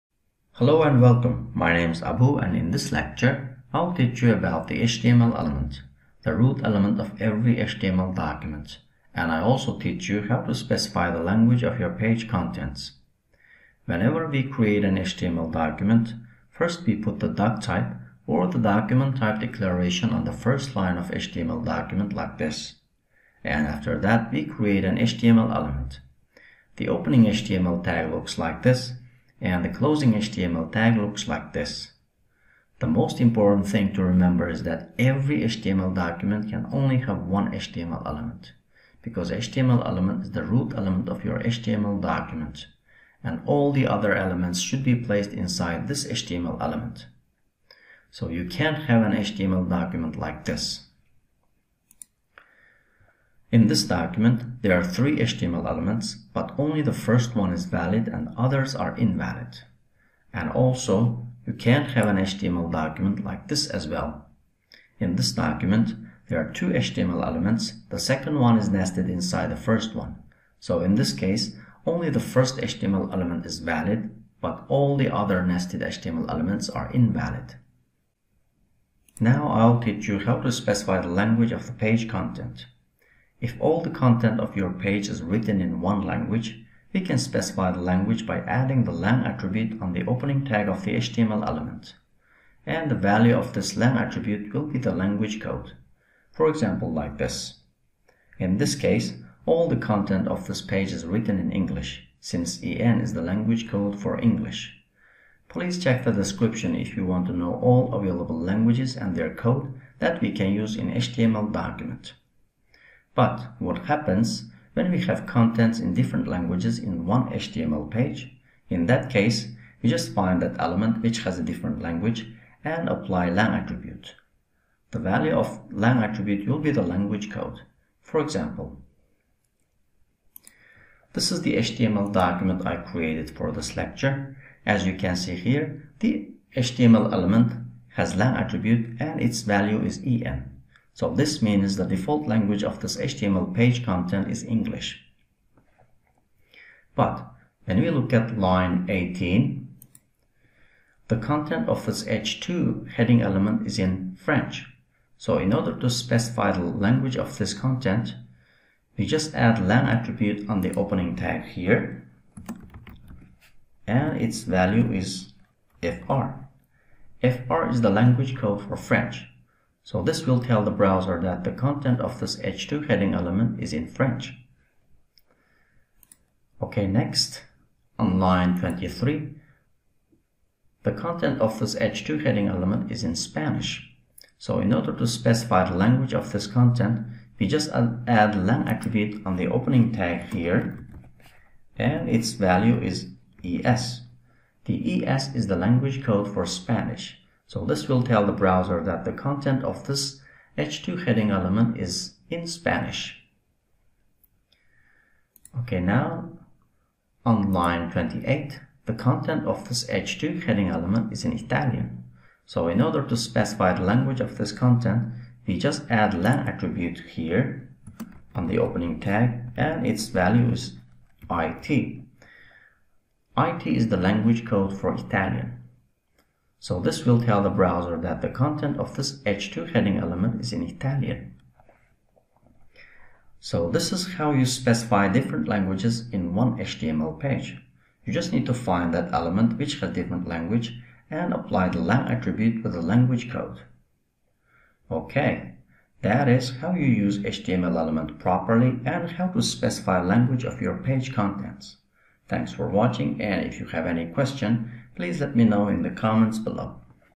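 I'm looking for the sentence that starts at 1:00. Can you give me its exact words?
And also, you can't have an HTML document like this as well.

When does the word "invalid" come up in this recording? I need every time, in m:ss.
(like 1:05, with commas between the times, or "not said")
0:58, 1:16.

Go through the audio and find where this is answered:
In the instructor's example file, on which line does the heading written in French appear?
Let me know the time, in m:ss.
2:28.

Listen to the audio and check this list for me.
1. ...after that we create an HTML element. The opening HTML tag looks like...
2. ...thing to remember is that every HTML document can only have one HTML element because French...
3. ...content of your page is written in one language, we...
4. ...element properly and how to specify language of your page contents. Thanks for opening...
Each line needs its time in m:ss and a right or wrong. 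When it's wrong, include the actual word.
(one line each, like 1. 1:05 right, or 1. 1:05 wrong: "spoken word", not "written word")
1. 0:23 right
2. 0:33 wrong: "HTML", not "French"
3. 1:23 right
4. 4:07 wrong: "watching", not "opening".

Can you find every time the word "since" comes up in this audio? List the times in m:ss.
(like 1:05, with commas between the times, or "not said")
1:42.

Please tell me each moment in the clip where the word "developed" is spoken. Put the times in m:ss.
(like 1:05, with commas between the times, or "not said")
not said.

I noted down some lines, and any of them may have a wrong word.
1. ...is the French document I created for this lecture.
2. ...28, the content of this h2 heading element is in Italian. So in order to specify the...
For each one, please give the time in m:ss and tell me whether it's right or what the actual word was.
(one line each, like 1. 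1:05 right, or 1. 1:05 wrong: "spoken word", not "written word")
1. 2:11 wrong: "HTML", not "French"
2. 3:27 right.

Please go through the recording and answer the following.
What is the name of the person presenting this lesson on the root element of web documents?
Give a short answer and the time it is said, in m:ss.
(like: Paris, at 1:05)
Abu, at 0:02.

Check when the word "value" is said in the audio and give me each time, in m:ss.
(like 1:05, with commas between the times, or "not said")
1:32, 2:04, 2:19, 2:44, 3:12, 3:40.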